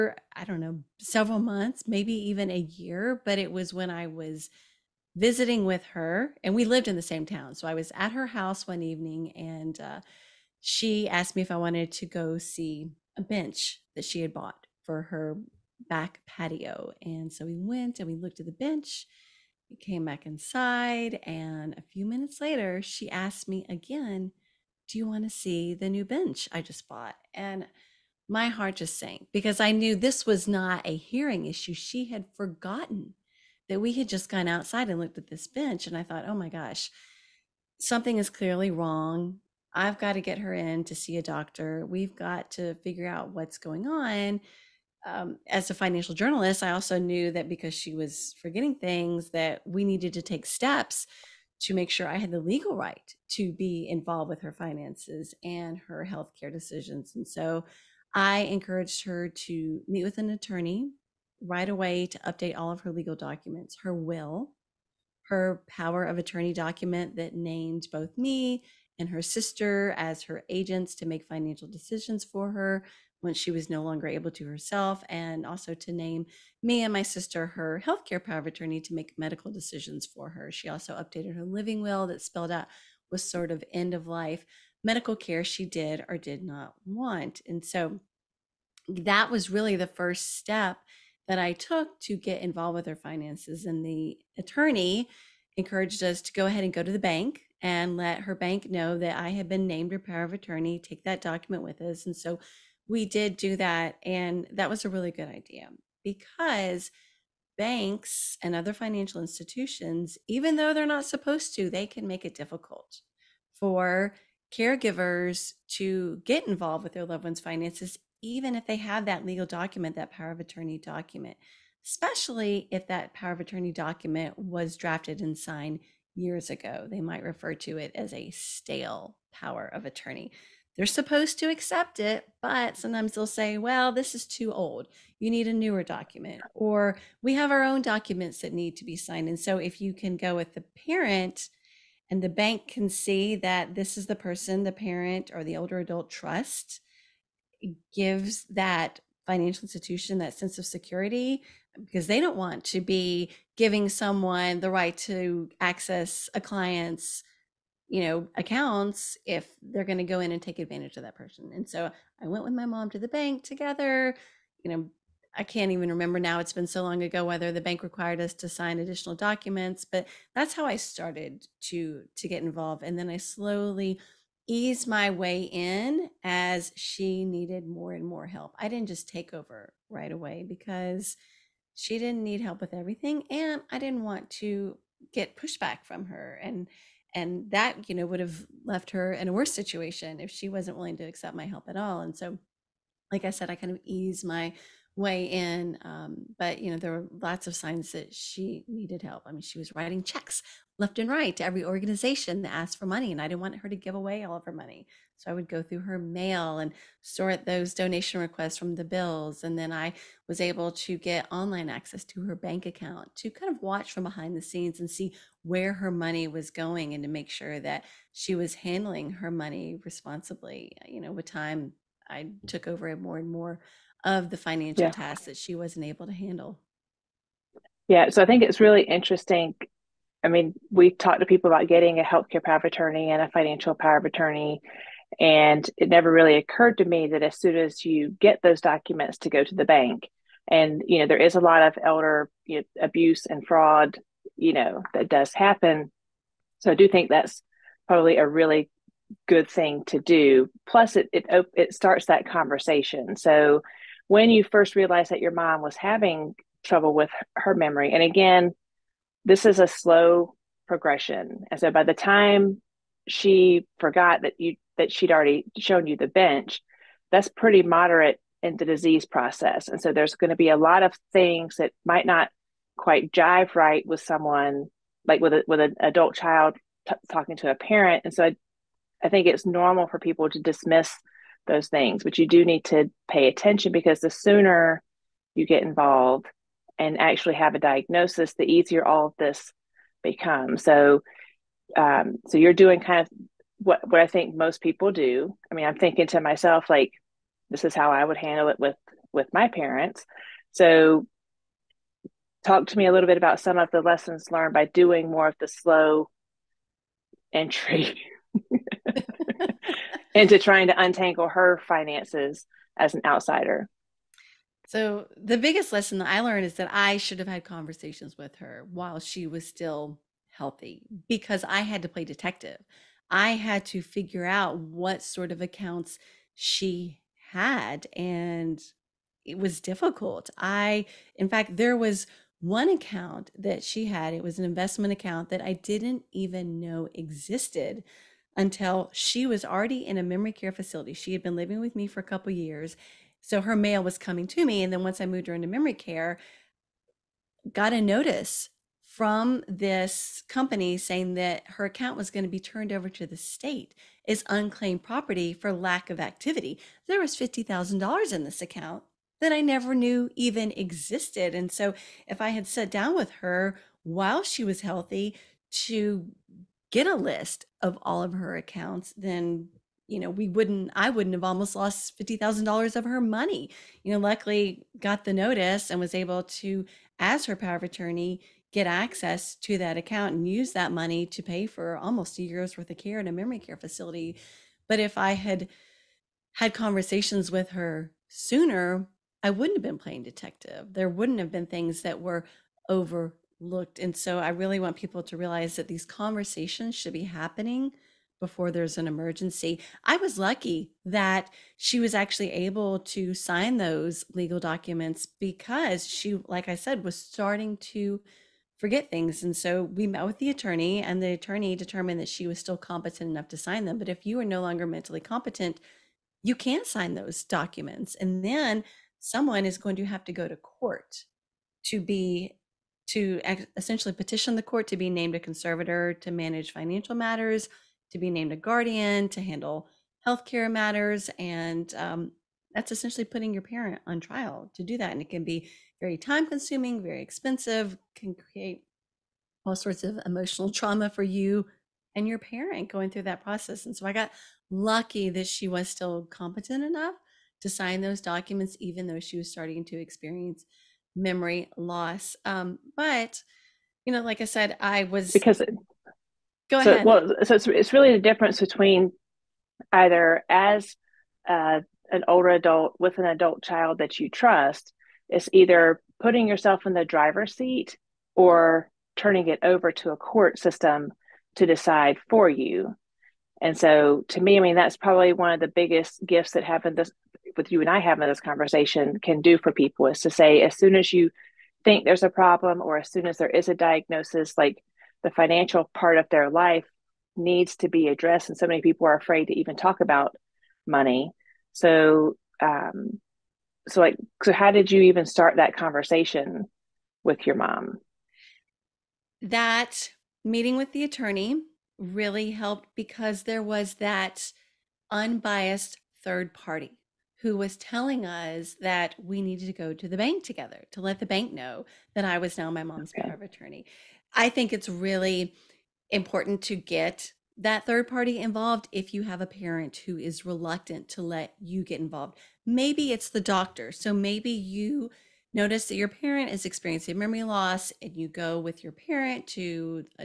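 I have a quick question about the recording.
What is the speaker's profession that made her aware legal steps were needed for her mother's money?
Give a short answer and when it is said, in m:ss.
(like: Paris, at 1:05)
Financial journalist, at 0:45.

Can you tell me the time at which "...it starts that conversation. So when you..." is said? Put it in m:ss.
4:11.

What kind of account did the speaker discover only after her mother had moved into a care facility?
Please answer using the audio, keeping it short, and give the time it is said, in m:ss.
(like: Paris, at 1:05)
Investment account, at 5:34.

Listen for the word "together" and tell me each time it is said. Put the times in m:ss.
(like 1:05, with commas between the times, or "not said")
2:43, 8:30.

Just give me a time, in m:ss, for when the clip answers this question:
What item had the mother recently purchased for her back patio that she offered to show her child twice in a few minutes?
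0:13.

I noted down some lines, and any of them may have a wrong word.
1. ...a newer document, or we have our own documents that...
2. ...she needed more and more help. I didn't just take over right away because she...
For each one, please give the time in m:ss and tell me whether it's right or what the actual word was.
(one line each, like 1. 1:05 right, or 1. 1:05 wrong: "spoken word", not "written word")
1. 2:15 right
2. 2:56 right.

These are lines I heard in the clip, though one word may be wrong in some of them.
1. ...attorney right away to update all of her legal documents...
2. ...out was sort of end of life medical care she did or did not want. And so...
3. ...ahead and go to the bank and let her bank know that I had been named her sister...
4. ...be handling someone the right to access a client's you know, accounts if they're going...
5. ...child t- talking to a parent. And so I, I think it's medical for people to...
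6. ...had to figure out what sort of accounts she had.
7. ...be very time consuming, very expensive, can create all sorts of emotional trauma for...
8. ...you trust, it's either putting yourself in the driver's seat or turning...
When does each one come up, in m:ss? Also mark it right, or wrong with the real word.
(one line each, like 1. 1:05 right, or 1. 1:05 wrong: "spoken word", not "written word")
1. 1:00 right
2. 1:22 right
3. 1:36 wrong: "power", not "sister"
4. 2:32 wrong: "giving", not "handling"
5. 4:36 wrong: "normal", not "medical"
6. 5:23 right
7. 7:15 right
8. 7:43 right.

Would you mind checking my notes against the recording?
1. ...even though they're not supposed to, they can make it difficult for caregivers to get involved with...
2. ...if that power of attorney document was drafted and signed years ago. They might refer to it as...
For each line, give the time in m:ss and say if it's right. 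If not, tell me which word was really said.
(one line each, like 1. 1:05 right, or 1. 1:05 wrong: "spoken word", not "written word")
1. 1:50 right
2. 2:02 right.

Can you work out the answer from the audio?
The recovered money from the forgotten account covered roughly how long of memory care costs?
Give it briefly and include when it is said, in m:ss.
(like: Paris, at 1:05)
Almost a year, at 6:21.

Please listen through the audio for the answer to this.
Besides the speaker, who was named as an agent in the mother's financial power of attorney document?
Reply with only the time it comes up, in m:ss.
1:09.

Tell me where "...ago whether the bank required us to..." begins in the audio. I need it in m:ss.
2:47.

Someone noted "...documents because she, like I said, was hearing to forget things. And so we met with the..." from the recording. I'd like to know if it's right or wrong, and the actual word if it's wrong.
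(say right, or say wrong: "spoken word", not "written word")
wrong: "starting", not "hearing".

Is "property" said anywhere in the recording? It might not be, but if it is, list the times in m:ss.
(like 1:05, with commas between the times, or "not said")
5:54.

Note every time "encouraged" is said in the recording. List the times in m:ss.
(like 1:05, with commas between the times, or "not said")
0:58, 1:35.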